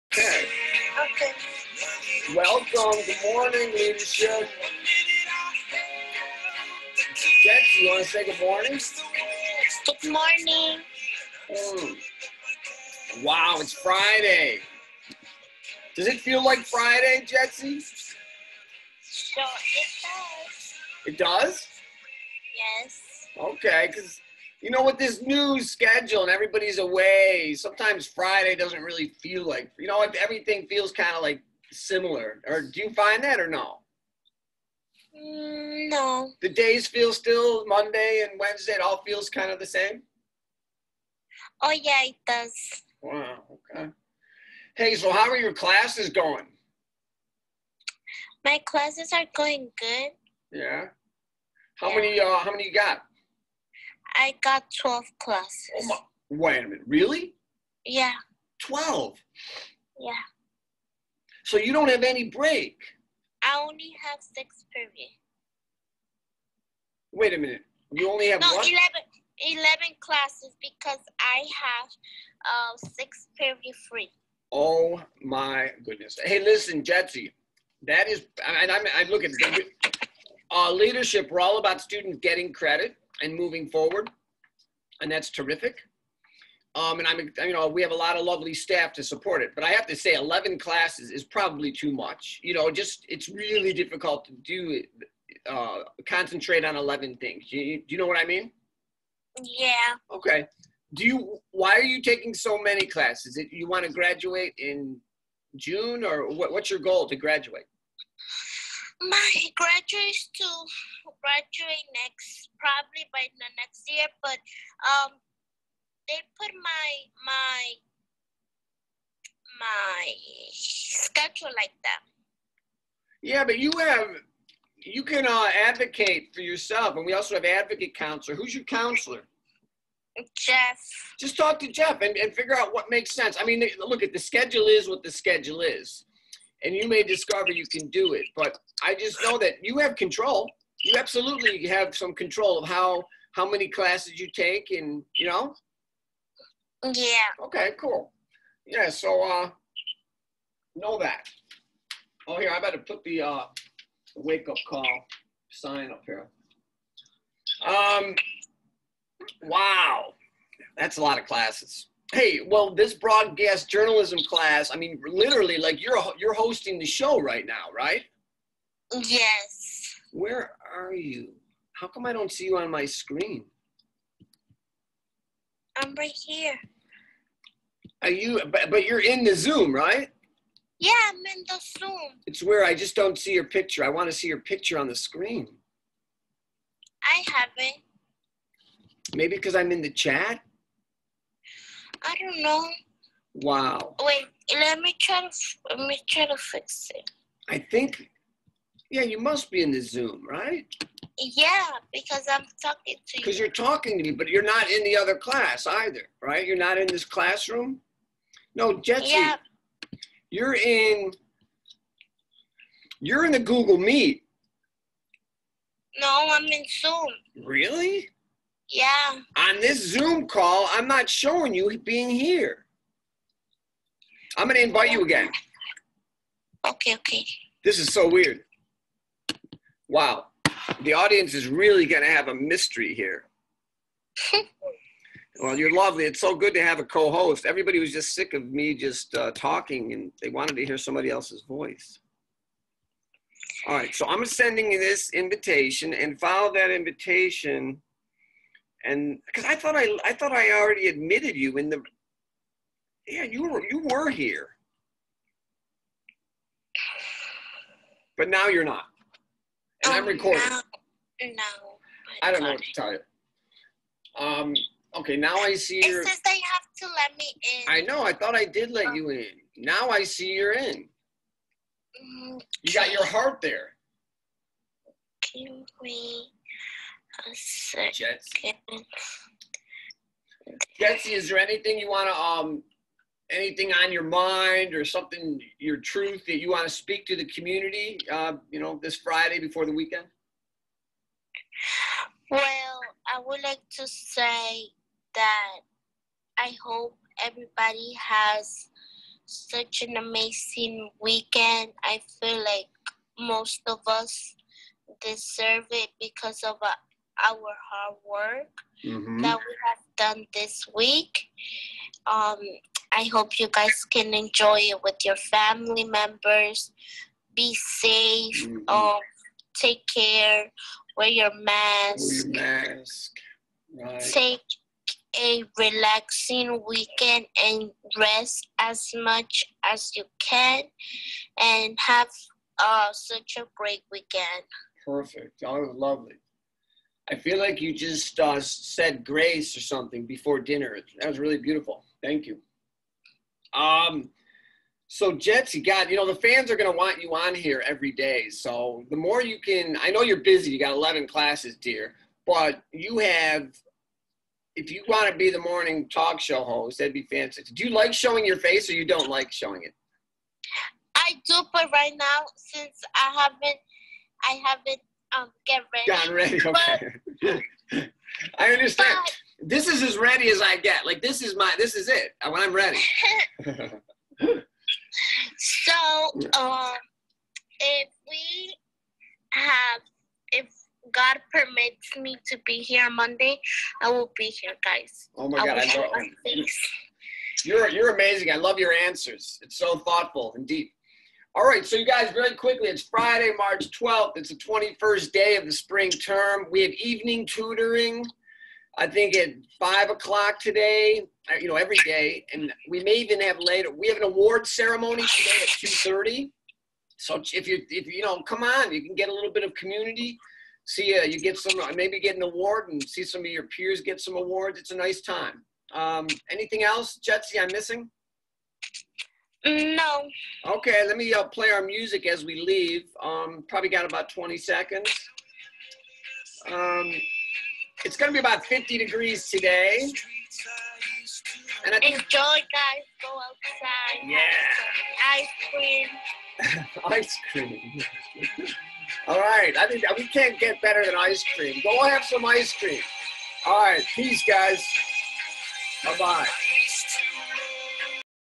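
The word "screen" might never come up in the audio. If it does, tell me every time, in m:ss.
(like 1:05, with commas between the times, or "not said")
2:52, 3:04.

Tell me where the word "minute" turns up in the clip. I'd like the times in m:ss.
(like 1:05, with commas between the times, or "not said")
0:56, 1:07.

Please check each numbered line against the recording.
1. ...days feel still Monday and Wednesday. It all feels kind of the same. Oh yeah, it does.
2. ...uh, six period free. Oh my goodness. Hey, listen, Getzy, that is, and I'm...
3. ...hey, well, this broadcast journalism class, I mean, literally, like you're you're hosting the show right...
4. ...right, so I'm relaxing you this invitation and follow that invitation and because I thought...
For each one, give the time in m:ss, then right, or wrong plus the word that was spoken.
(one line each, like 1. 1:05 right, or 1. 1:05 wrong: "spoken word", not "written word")
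1. 0:36 right
2. 1:12 right
3. 2:42 right
4. 4:03 wrong: "sending", not "relaxing".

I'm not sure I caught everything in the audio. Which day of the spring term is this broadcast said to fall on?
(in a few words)
21st day.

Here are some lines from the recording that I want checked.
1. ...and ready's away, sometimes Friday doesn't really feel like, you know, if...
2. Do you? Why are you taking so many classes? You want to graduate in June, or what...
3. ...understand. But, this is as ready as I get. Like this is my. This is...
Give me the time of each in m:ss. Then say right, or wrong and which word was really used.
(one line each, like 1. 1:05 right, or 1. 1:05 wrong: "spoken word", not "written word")
1. 0:26 wrong: "everybody", not "ready"
2. 1:40 right
3. 6:08 right.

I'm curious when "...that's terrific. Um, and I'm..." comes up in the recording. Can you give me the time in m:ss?
1:25.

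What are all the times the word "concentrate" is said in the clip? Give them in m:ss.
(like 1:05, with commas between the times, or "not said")
1:36.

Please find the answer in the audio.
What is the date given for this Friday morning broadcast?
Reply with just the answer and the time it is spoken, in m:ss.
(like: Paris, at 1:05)
March 12th, at 6:33.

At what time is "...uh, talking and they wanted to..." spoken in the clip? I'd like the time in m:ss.
3:59.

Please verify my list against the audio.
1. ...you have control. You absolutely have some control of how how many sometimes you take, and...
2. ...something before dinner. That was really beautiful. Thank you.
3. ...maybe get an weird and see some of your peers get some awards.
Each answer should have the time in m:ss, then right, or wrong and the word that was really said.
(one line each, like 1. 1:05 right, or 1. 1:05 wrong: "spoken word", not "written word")
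1. 2:19 wrong: "classes", not "sometimes"
2. 5:39 right
3. 6:51 wrong: "award", not "weird".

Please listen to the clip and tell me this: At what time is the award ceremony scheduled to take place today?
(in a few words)
2:30.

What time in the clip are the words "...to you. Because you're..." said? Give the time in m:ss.
3:22.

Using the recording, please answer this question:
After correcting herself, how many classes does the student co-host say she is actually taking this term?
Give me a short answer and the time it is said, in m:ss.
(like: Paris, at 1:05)
11, at 1:08.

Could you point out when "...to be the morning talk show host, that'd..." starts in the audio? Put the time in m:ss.
5:55.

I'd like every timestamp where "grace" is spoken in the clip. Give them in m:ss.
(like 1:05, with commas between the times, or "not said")
5:39.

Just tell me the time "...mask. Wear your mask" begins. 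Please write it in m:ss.
5:21.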